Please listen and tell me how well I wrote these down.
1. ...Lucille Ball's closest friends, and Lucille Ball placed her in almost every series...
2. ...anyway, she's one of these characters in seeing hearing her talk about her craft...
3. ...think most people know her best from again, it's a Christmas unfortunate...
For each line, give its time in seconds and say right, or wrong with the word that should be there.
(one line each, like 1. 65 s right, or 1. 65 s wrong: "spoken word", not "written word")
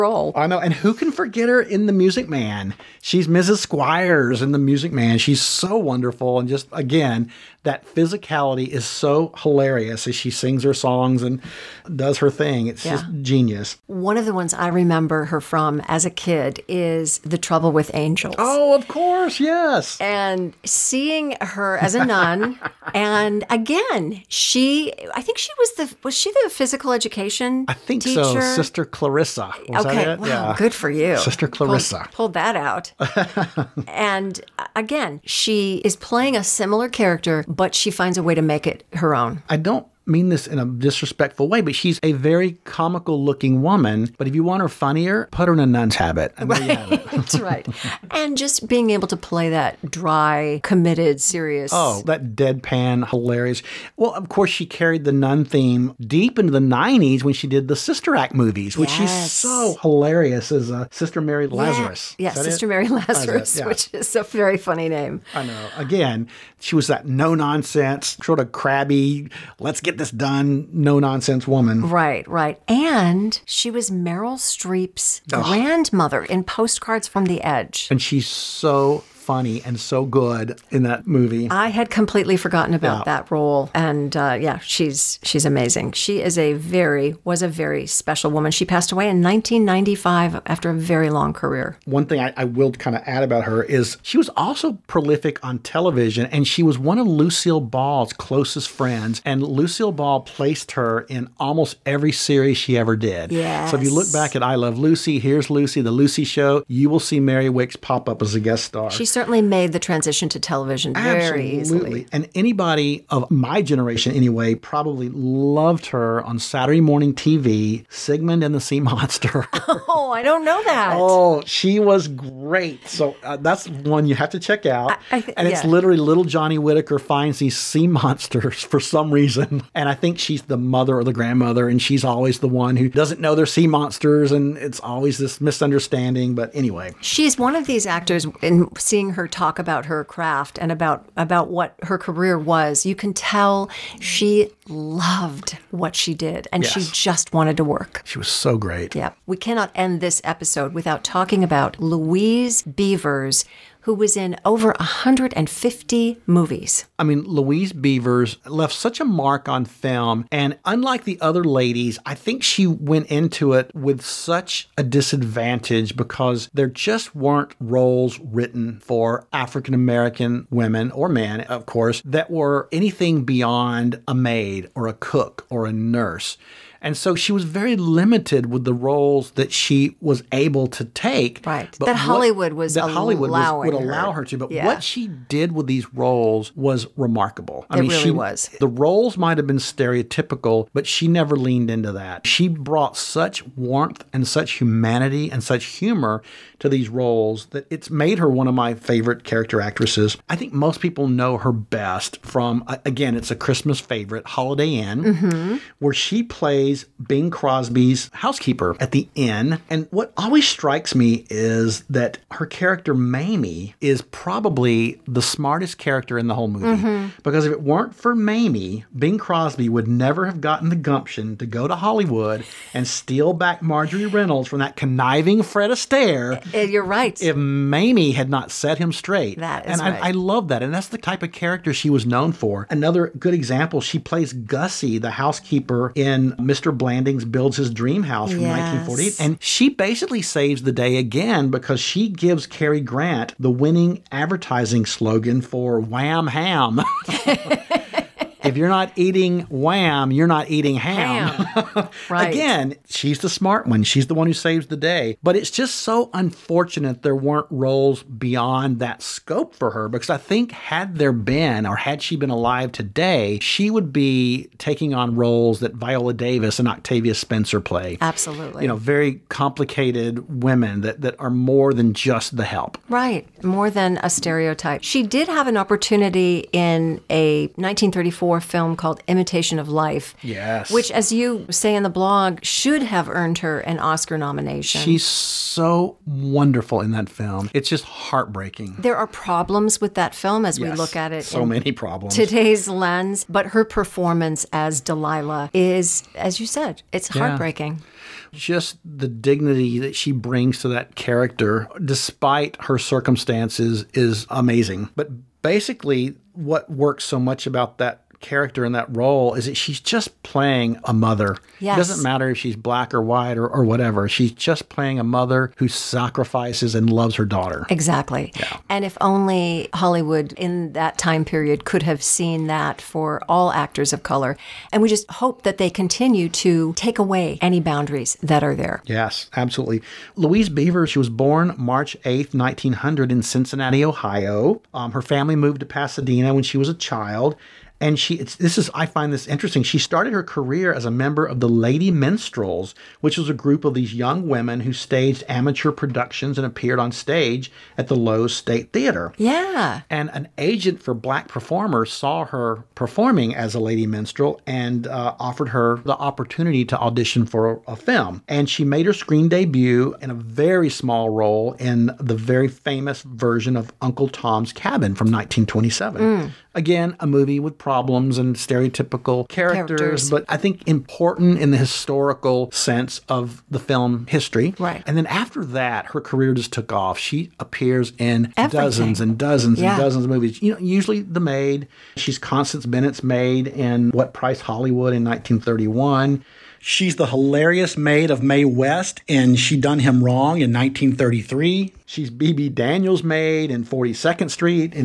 1. 97 s right
2. 136 s wrong: "actors", not "characters"
3. 200 s wrong: "favorite", not "unfortunate".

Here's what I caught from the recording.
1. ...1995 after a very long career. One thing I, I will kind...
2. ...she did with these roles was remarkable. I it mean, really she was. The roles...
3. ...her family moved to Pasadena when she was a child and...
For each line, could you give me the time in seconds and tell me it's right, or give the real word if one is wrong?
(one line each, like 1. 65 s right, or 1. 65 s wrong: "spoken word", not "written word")
1. 89 s right
2. 184 s right
3. 334 s right.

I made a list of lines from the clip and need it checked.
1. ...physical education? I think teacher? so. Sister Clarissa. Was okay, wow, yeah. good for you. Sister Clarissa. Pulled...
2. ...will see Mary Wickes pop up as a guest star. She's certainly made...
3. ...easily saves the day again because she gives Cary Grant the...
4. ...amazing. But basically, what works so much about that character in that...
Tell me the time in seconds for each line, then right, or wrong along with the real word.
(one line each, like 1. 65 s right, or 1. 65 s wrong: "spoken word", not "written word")
1. 26 s right
2. 106 s right
3. 239 s wrong: "basically", not "easily"
4. 304 s right.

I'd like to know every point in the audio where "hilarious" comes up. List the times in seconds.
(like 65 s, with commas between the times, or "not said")
9 s, 53 s, 59 s, 387 s.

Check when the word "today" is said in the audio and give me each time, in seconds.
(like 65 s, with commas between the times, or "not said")
262 s, 292 s.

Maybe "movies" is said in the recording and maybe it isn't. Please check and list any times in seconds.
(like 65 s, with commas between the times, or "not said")
58 s, 81 s, 156 s, 216 s, 367 s, 380 s.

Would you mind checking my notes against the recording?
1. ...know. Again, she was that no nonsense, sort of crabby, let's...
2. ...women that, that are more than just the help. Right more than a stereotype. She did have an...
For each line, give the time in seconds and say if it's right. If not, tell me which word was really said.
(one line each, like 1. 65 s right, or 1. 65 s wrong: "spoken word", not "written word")
1. 65 s right
2. 270 s right.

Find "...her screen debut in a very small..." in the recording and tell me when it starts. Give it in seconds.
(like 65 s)
358 s.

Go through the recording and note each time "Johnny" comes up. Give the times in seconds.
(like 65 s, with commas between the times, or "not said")
126 s.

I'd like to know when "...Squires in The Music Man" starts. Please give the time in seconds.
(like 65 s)
3 s.